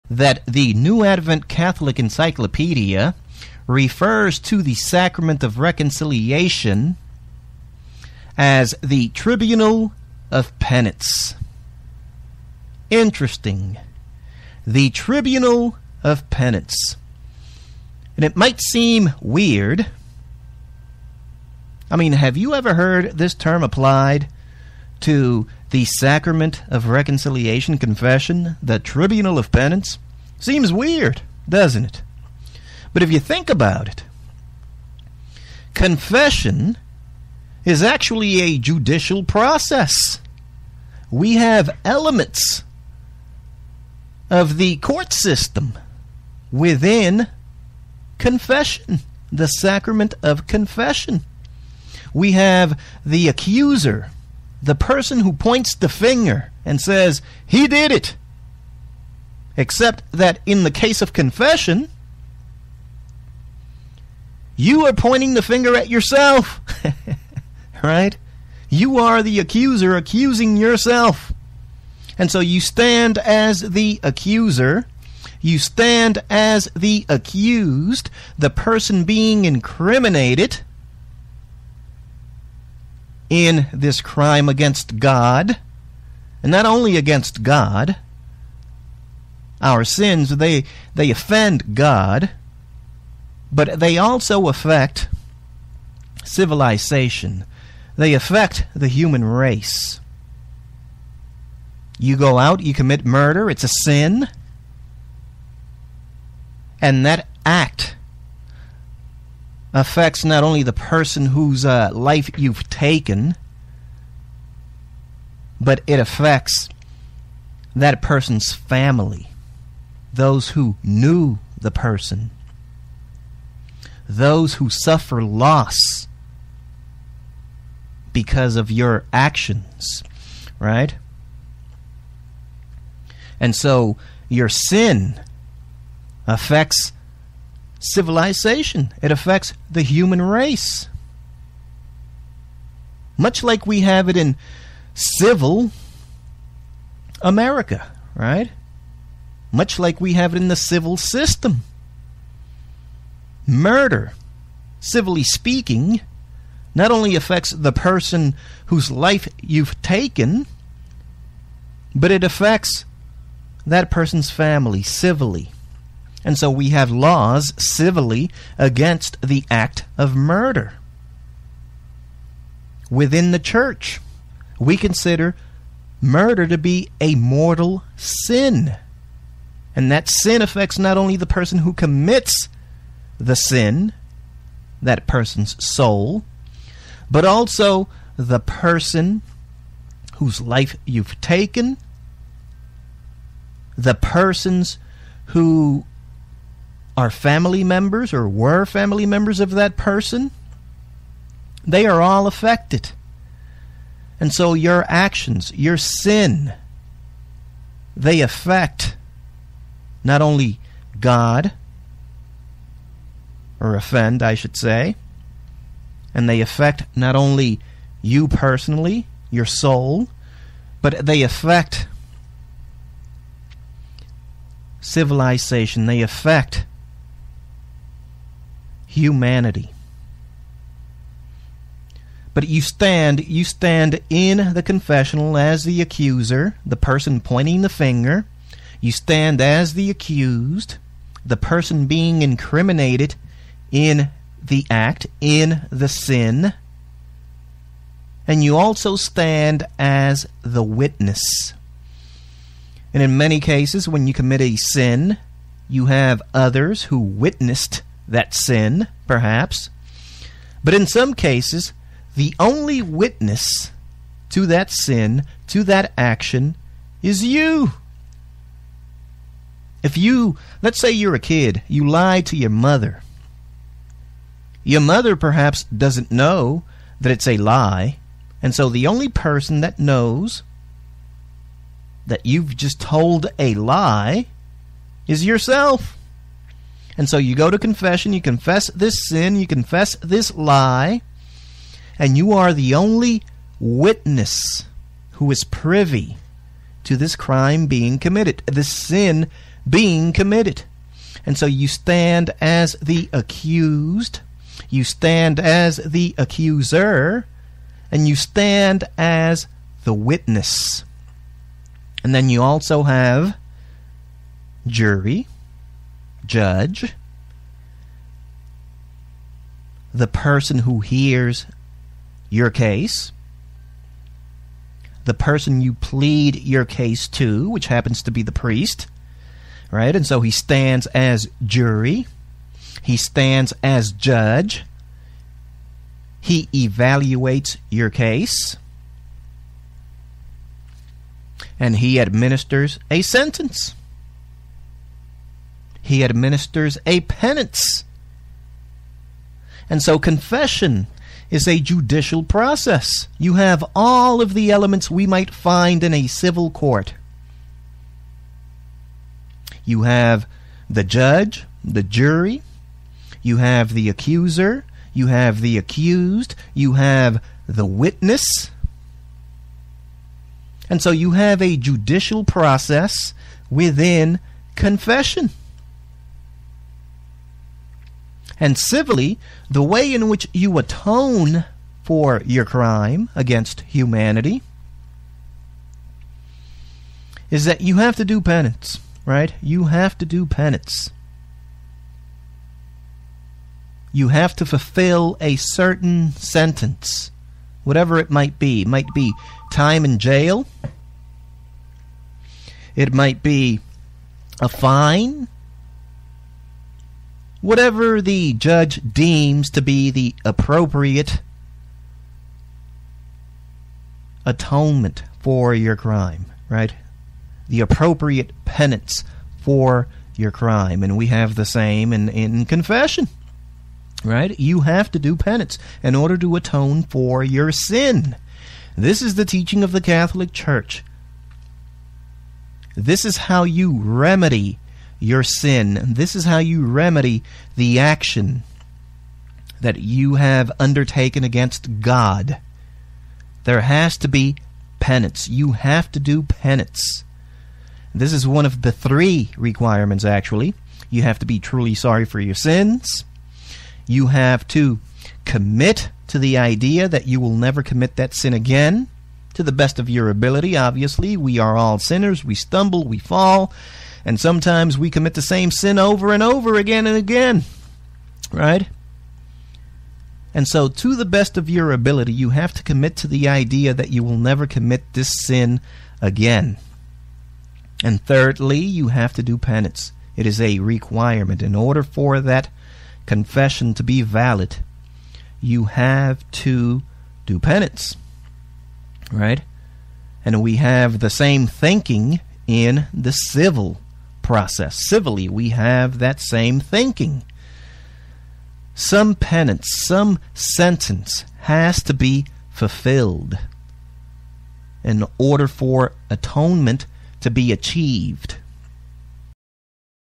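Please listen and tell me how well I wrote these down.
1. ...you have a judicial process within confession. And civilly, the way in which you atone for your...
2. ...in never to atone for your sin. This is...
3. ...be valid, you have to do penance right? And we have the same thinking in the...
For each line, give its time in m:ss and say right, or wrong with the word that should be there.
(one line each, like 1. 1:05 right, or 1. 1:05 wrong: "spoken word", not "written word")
1. 6:10 right
2. 7:05 wrong: "order", not "never"
3. 8:03 right.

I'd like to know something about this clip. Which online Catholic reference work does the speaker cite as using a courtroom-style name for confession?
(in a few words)
New Advent Catholic Encyclopedia.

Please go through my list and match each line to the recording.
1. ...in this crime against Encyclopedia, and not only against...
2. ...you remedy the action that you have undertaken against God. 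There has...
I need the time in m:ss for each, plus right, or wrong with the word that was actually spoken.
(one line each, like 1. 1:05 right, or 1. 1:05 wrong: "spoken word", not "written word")
1. 1:23 wrong: "God", not "Encyclopedia"
2. 7:16 right.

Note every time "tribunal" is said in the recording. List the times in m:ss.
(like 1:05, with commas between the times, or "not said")
0:09, 0:14, 0:28.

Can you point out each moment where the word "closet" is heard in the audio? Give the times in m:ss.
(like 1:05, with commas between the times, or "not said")
not said.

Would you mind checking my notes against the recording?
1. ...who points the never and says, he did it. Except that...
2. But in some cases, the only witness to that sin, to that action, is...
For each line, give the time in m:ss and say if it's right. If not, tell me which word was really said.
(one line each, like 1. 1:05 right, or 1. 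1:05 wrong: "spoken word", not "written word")
1. 0:55 wrong: "finger", not "never"
2. 4:20 right.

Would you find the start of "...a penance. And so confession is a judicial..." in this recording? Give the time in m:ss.
5:46.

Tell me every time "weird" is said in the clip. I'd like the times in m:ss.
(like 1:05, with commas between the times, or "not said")
0:19, 0:30.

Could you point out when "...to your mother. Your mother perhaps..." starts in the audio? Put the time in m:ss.
4:32.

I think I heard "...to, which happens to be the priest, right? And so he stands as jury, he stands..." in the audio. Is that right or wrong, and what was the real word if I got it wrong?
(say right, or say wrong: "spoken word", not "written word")
right.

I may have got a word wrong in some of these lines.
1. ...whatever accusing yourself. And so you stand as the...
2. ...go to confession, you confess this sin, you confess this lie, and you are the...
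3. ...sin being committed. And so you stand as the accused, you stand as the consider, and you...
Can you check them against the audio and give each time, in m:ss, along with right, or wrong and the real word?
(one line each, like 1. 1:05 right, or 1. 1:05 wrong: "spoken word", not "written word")
1. 1:09 wrong: "accuser", not "whatever"
2. 4:47 right
3. 4:58 wrong: "accuser", not "consider".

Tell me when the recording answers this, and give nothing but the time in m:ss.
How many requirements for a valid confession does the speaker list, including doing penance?
7:28.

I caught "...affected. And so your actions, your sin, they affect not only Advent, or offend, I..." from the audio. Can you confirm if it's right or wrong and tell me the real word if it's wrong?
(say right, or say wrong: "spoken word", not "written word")
wrong: "God", not "Advent".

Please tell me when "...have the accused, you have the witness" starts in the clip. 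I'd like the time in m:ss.
6:05.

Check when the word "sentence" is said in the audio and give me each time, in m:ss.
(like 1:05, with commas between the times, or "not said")
5:43, 6:36, 8:20.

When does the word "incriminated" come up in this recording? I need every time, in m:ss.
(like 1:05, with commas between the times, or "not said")
1:19, 4:02.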